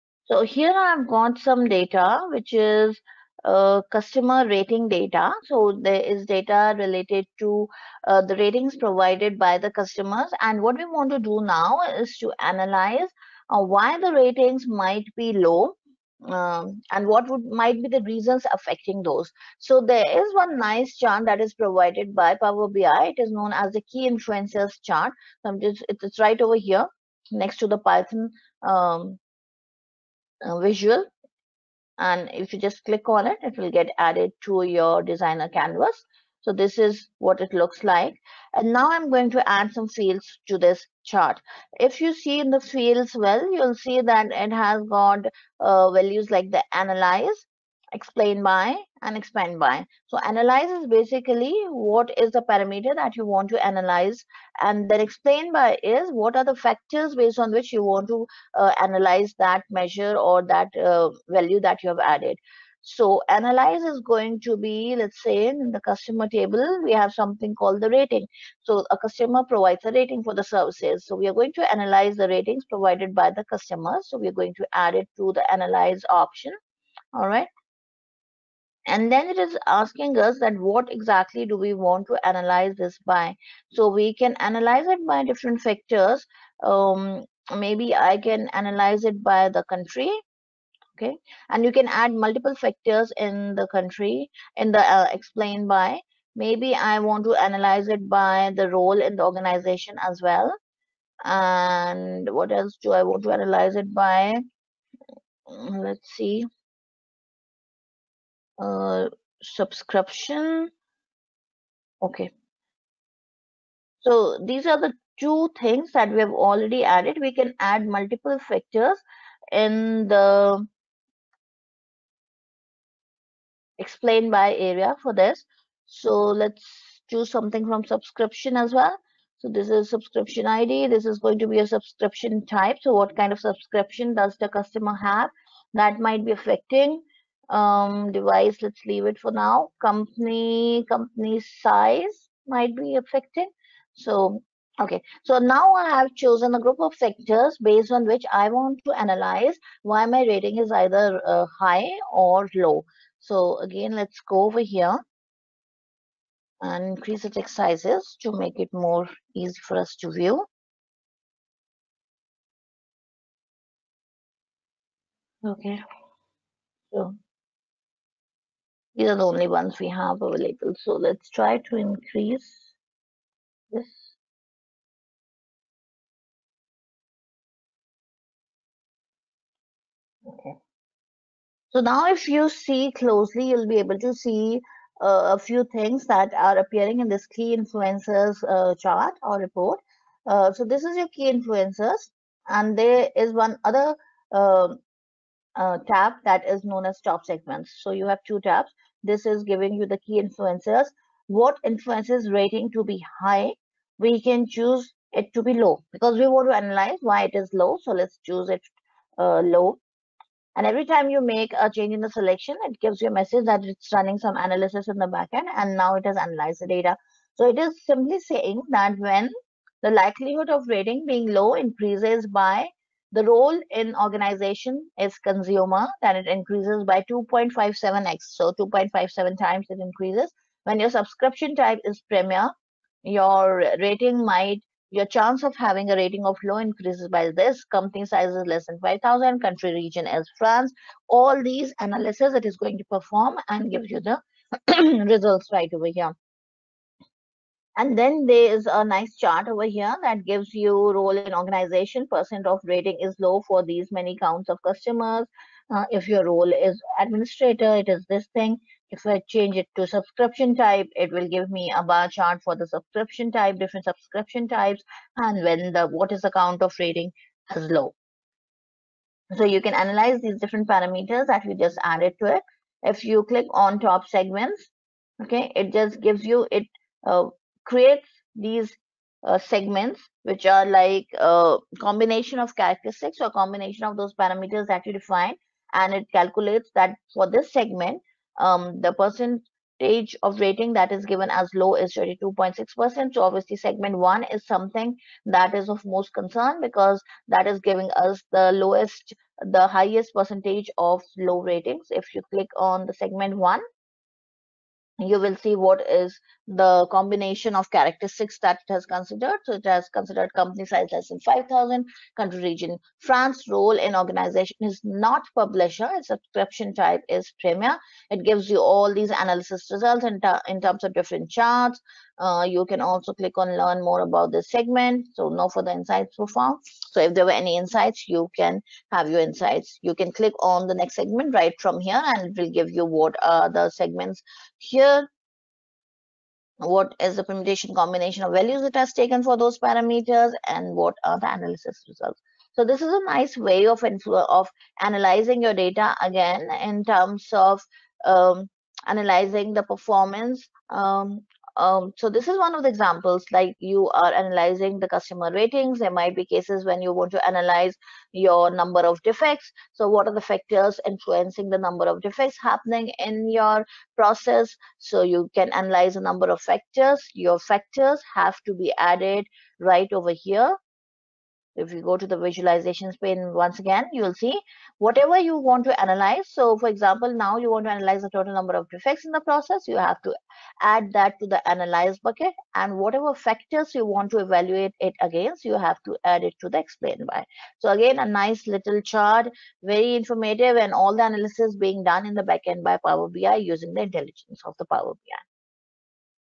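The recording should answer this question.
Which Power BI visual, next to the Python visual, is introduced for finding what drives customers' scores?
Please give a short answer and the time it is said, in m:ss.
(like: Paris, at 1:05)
key influencers chart, at 0:23.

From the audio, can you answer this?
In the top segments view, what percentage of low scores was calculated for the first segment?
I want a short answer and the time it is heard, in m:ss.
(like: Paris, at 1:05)
32.6%, at 4:51.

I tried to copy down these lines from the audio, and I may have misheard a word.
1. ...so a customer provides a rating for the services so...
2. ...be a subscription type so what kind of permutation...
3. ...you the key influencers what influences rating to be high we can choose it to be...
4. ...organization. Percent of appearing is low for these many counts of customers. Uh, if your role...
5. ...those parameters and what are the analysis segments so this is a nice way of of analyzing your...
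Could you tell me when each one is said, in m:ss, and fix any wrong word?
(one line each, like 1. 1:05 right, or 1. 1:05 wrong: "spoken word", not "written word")
1. 1:08 right
2. 2:11 wrong: "subscription", not "permutation"
3. 3:19 right
4. 4:11 wrong: "rating", not "appearing"
5. 5:39 wrong: "results", not "segments".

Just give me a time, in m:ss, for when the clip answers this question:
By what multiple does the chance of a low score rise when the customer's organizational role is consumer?
3:47.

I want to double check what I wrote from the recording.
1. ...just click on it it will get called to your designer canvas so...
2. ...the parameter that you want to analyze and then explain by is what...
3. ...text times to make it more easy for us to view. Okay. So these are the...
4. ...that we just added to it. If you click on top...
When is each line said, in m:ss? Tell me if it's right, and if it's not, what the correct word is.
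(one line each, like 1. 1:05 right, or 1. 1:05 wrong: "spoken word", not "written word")
1. 0:32 wrong: "added", not "called"
2. 0:52 right
3. 2:37 wrong: "sizes", not "times"
4. 4:31 right.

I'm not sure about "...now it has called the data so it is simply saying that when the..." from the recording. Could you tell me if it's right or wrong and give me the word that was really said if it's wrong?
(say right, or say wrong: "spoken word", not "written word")
wrong: "analyzed", not "called".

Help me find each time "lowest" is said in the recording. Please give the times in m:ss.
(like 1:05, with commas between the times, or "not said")
4:58.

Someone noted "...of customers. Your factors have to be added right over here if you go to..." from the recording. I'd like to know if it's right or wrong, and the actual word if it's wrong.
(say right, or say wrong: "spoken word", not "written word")
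wrong: "factors", not "customers".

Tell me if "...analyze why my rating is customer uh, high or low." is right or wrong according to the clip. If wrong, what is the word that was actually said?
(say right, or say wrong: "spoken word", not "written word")
wrong: "either", not "customer".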